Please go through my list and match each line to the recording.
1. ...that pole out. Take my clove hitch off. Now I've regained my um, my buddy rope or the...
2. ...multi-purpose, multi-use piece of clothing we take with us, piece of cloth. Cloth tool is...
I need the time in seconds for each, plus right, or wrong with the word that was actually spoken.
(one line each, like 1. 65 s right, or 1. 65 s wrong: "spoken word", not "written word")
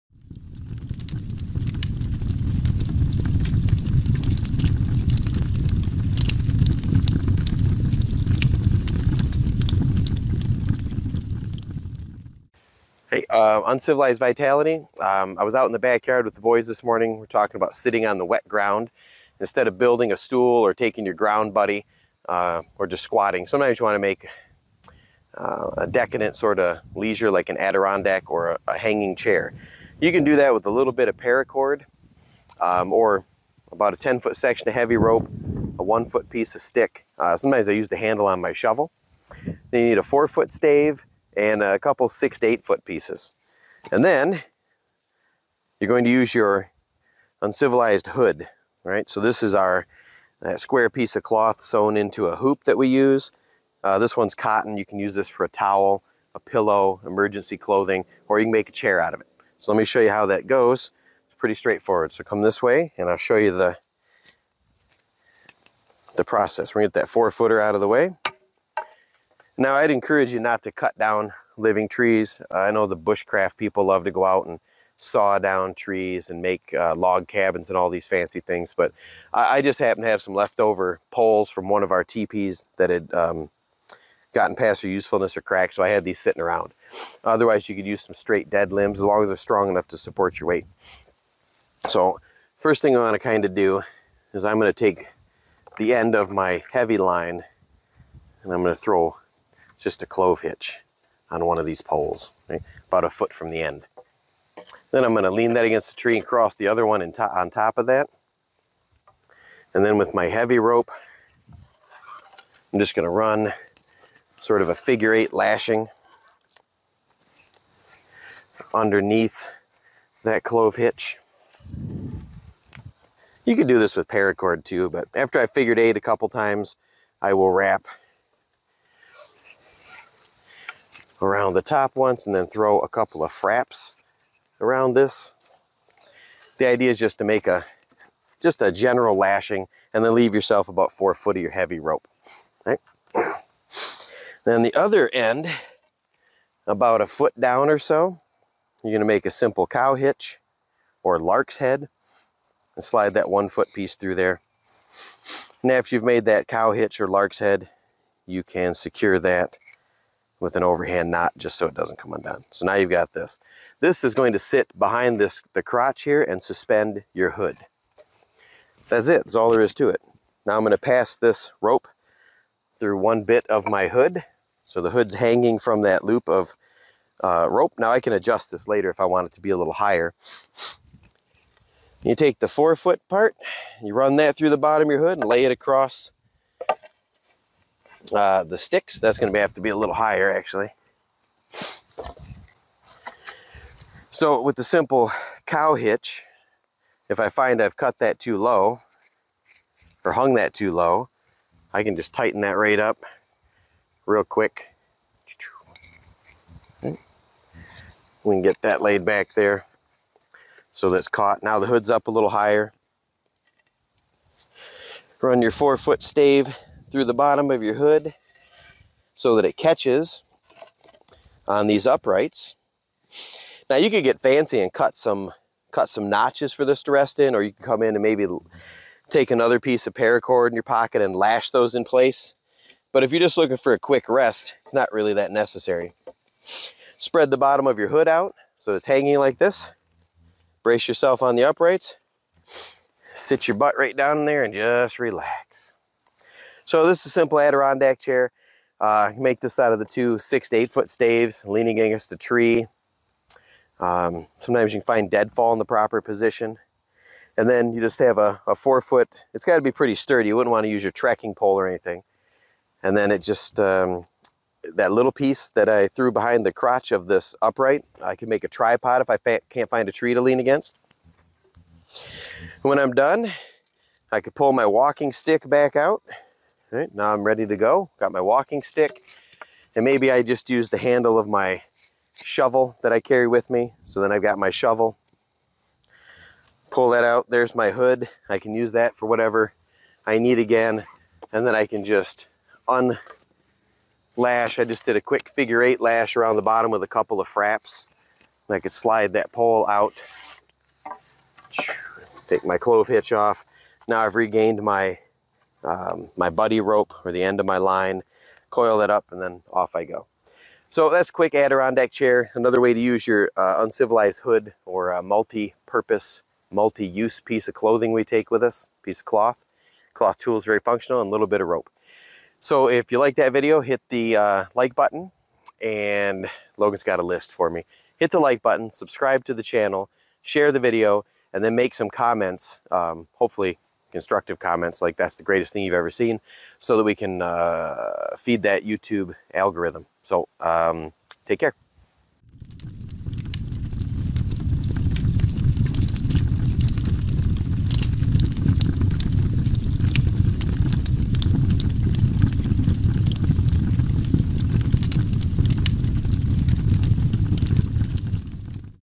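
1. 299 s right
2. 315 s right.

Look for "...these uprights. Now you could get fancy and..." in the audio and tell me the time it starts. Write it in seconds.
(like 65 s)
221 s.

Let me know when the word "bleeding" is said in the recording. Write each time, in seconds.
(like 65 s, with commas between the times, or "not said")
not said.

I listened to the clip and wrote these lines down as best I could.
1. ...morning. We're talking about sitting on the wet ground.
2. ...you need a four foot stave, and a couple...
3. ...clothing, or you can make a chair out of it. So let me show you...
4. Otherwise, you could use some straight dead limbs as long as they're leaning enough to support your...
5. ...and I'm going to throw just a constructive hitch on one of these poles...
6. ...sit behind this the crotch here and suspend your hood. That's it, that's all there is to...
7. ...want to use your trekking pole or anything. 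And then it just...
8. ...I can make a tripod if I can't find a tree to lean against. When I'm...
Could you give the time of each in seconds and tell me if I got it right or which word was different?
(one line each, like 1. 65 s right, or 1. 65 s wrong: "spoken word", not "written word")
1. 16 s right
2. 39 s right
3. 57 s right
4. 87 s wrong: "strong", not "leaning"
5. 98 s wrong: "clove", not "constructive"
6. 164 s right
7. 260 s right
8. 268 s right.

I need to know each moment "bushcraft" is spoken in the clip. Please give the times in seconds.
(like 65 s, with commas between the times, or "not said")
72 s.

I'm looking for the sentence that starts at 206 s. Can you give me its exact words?
We can get that laid back there so that's caught.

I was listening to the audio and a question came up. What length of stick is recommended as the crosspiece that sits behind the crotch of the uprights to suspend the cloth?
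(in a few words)
1 foot.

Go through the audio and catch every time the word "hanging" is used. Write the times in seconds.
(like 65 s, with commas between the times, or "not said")
28 s, 175 s, 238 s.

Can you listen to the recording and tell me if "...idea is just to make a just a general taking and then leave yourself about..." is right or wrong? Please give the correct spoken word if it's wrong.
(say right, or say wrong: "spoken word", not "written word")
wrong: "lashing", not "taking".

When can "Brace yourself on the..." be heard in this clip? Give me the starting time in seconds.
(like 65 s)
240 s.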